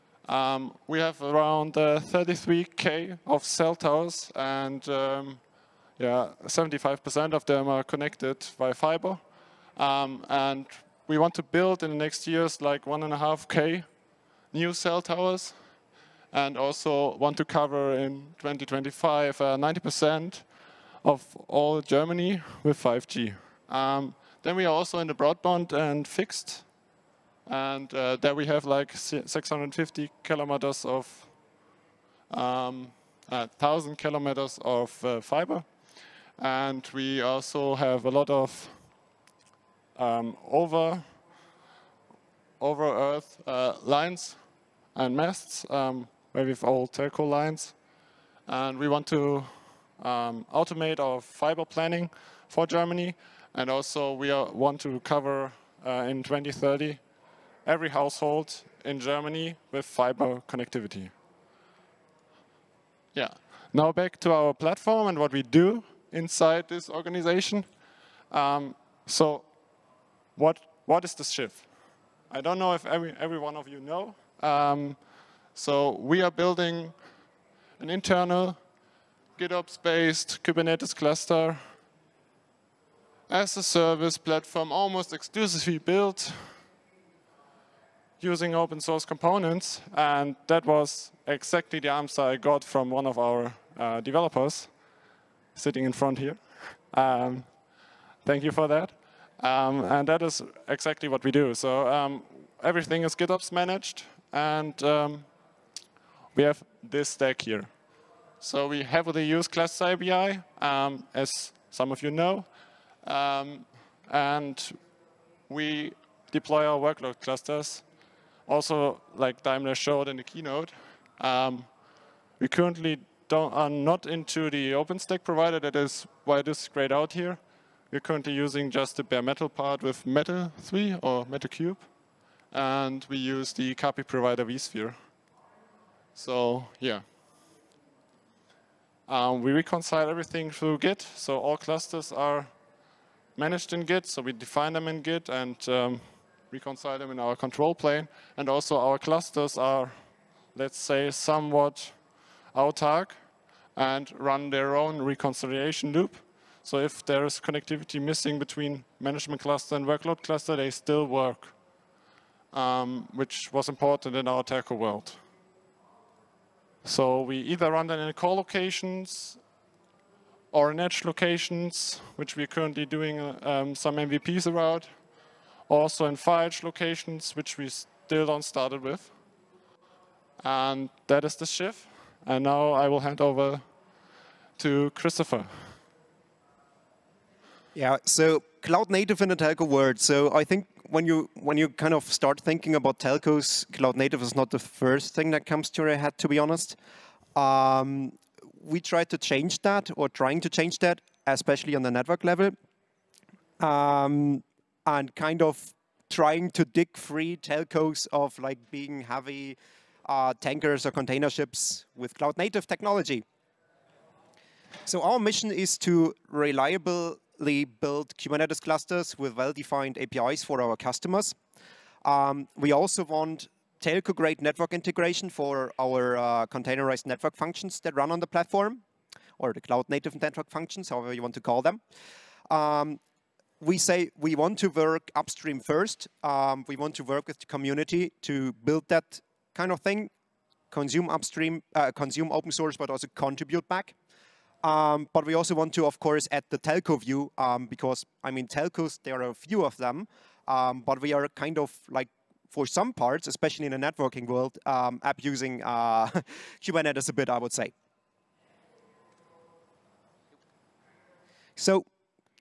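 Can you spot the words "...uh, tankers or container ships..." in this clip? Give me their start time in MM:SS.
03:30.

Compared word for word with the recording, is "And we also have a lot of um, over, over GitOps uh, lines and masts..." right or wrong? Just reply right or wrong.
wrong.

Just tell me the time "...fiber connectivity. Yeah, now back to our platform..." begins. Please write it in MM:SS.
00:59.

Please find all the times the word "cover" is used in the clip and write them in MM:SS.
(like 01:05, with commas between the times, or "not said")
00:17, 00:55.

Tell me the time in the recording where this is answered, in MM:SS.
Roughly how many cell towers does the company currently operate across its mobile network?
00:01.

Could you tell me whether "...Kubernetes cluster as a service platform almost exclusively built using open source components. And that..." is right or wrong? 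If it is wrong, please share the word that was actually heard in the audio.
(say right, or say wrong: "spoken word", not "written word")
right.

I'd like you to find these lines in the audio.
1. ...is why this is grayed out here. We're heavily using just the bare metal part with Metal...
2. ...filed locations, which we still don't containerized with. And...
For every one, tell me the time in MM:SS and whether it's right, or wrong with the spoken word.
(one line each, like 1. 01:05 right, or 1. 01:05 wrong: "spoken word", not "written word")
1. 02:05 wrong: "currently", not "heavily"
2. 02:56 wrong: "started", not "containerized".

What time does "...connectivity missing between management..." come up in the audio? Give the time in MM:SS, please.
02:37.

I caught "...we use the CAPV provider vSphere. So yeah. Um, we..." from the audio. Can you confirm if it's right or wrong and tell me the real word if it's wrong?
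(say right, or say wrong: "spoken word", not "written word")
right.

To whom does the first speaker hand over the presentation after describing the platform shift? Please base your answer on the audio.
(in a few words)
Christopher.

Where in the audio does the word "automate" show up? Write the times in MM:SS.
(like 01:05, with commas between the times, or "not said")
00:50.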